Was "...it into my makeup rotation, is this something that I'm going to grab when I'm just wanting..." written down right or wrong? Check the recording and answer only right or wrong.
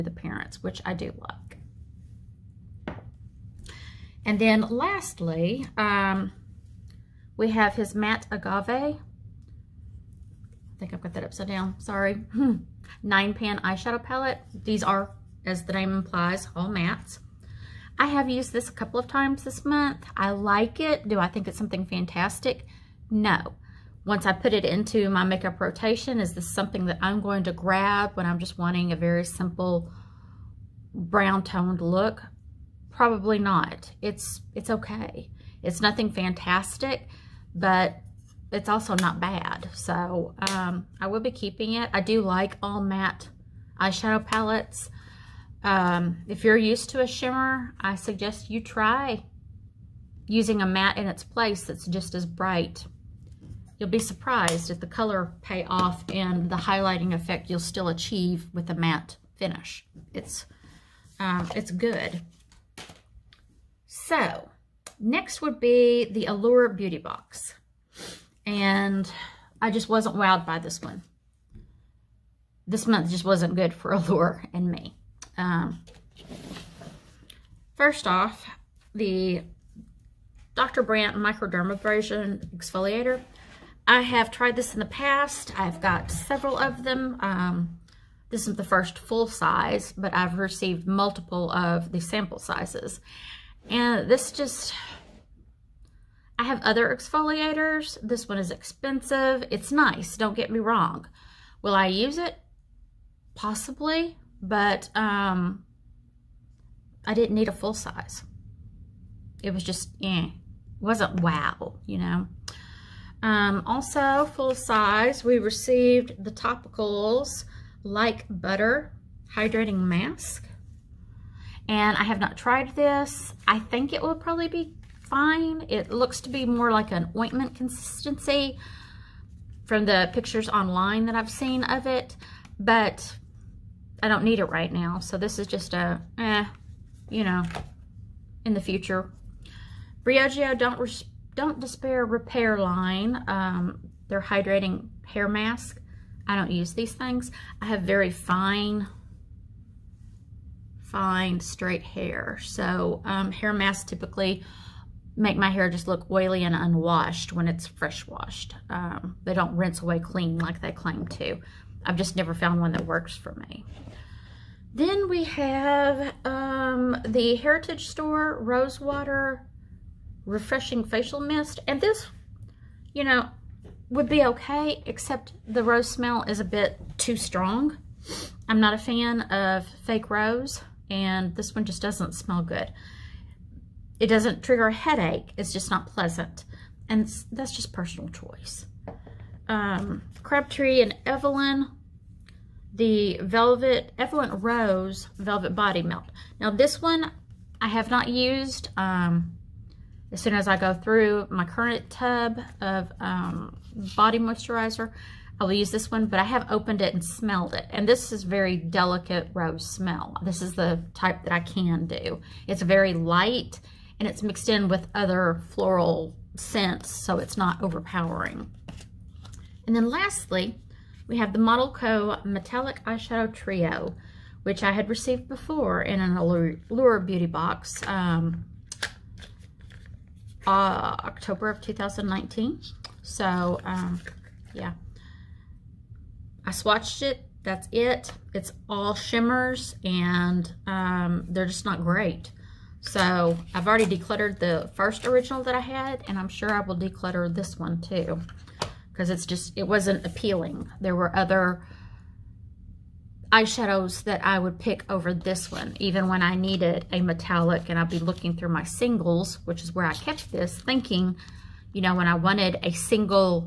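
right.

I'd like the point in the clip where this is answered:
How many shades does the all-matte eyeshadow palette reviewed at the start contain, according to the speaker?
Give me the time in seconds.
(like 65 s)
13 s.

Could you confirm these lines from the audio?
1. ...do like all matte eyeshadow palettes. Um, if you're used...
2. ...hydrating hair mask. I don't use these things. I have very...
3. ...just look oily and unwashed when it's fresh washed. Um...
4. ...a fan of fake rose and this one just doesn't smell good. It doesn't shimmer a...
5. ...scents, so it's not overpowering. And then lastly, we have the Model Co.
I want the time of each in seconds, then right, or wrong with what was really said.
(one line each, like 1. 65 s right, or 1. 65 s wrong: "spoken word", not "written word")
1. 41 s right
2. 144 s right
3. 155 s right
4. 178 s wrong: "trigger", not "shimmer"
5. 216 s right.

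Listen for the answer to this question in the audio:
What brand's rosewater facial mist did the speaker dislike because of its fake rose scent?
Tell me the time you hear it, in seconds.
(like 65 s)
167 s.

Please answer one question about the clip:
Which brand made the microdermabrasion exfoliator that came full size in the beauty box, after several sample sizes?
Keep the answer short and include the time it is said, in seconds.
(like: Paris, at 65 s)
Dr. Brandt, at 80 s.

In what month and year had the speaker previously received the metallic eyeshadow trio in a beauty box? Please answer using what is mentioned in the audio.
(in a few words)
October 2019.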